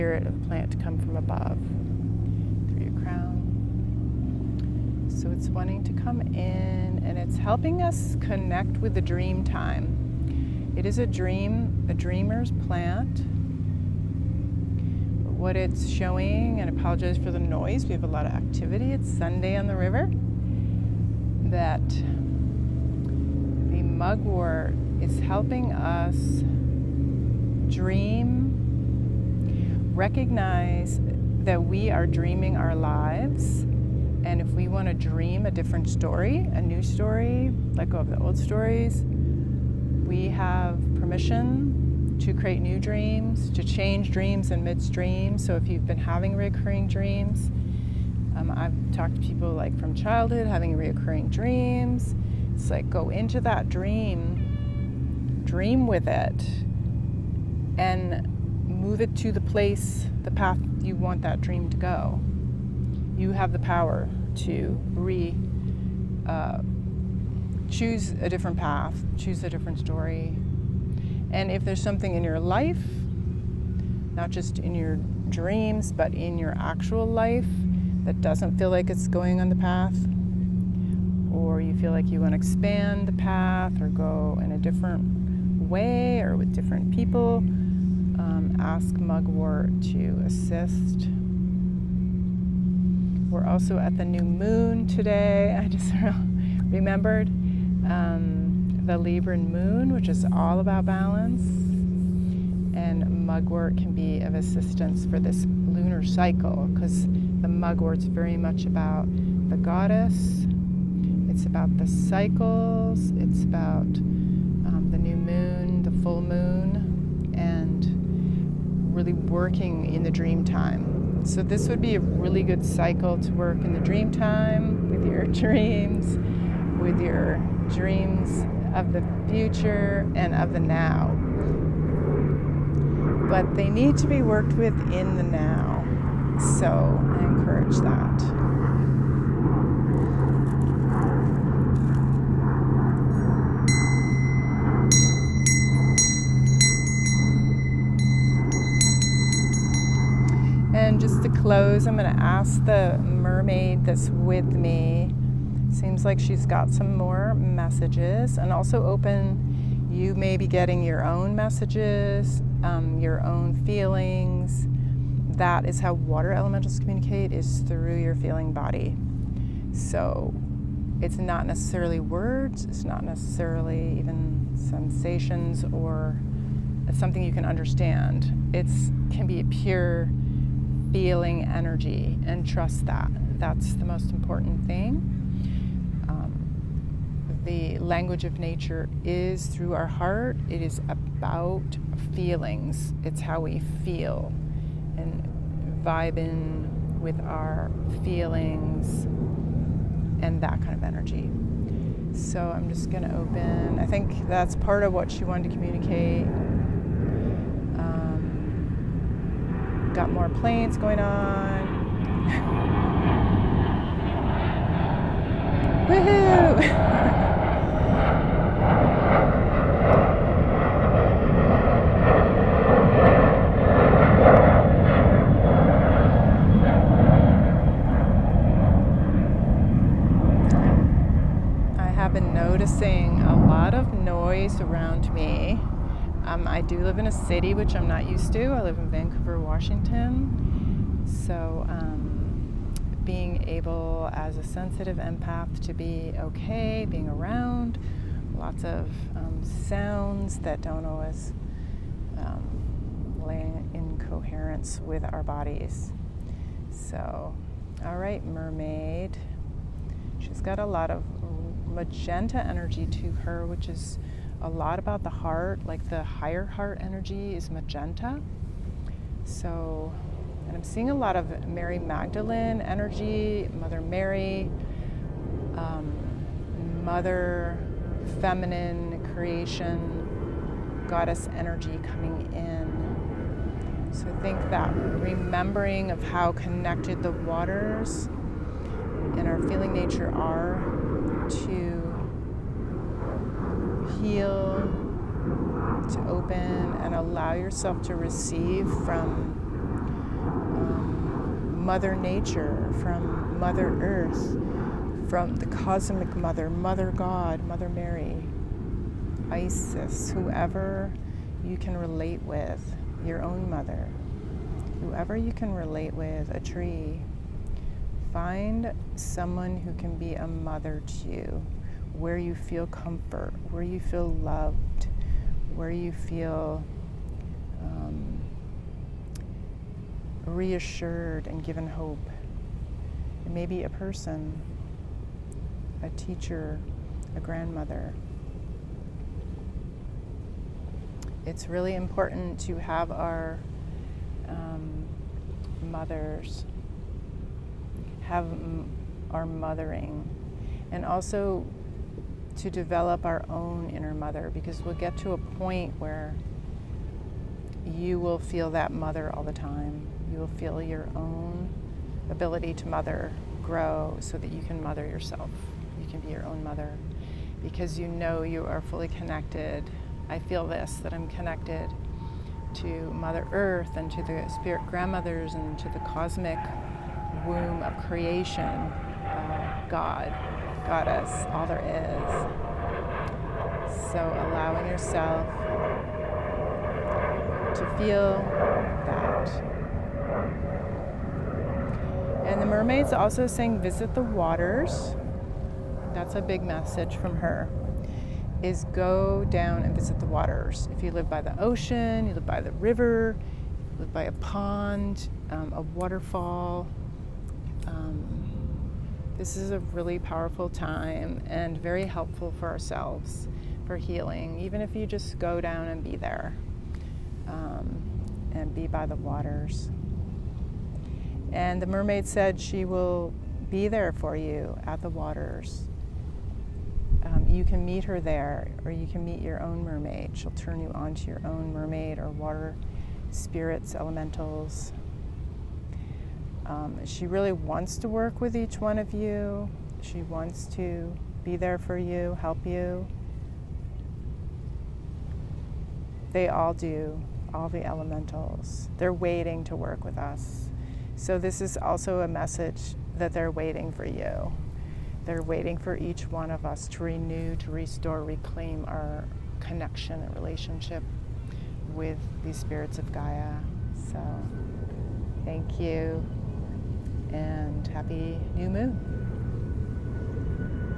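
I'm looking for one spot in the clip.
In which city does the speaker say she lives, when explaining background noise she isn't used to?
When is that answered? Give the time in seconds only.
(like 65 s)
238 s.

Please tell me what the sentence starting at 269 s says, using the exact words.
So, and I'm seeing a lot of Mary Magdalene energy, Mother Mary, um, Mother Feminine Creation, Goddess energy coming in.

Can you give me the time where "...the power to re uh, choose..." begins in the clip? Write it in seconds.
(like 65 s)
63 s.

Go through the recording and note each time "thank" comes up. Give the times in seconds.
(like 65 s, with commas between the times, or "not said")
465 s.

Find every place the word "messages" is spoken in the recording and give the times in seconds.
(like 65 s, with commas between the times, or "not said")
157 s, 161 s, 396 s, 452 s.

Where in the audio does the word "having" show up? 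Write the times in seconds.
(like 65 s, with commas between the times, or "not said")
45 s, 50 s.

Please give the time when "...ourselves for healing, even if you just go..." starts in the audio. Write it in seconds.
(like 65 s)
412 s.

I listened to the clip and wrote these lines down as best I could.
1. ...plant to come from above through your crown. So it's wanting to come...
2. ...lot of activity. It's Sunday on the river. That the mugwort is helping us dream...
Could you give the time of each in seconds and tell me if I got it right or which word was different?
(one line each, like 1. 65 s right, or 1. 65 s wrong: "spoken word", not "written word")
1. 0 s right
2. 18 s right.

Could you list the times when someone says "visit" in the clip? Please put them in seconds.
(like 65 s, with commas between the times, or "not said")
393 s, 399 s.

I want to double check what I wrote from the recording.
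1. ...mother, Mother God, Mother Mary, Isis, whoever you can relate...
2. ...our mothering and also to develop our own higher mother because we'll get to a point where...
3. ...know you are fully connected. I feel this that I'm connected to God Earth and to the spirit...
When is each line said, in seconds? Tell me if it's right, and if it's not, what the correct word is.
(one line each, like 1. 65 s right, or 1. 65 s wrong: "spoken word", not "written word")
1. 306 s right
2. 349 s wrong: "inner", not "higher"
3. 367 s wrong: "Mother", not "God".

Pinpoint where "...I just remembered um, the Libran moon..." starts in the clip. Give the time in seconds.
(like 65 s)
95 s.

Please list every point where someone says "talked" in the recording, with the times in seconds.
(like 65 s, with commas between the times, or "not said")
48 s.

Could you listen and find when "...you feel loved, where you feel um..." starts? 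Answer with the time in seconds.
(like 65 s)
323 s.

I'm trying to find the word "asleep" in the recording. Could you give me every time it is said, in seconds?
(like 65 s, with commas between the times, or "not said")
not said.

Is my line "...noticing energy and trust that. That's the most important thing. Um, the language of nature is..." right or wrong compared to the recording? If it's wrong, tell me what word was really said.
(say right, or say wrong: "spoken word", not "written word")
wrong: "feeling", not "noticing".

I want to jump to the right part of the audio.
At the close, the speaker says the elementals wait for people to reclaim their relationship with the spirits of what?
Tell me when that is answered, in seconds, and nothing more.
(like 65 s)
462 s.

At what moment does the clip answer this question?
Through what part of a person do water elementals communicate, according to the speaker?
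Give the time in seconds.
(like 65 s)
168 s.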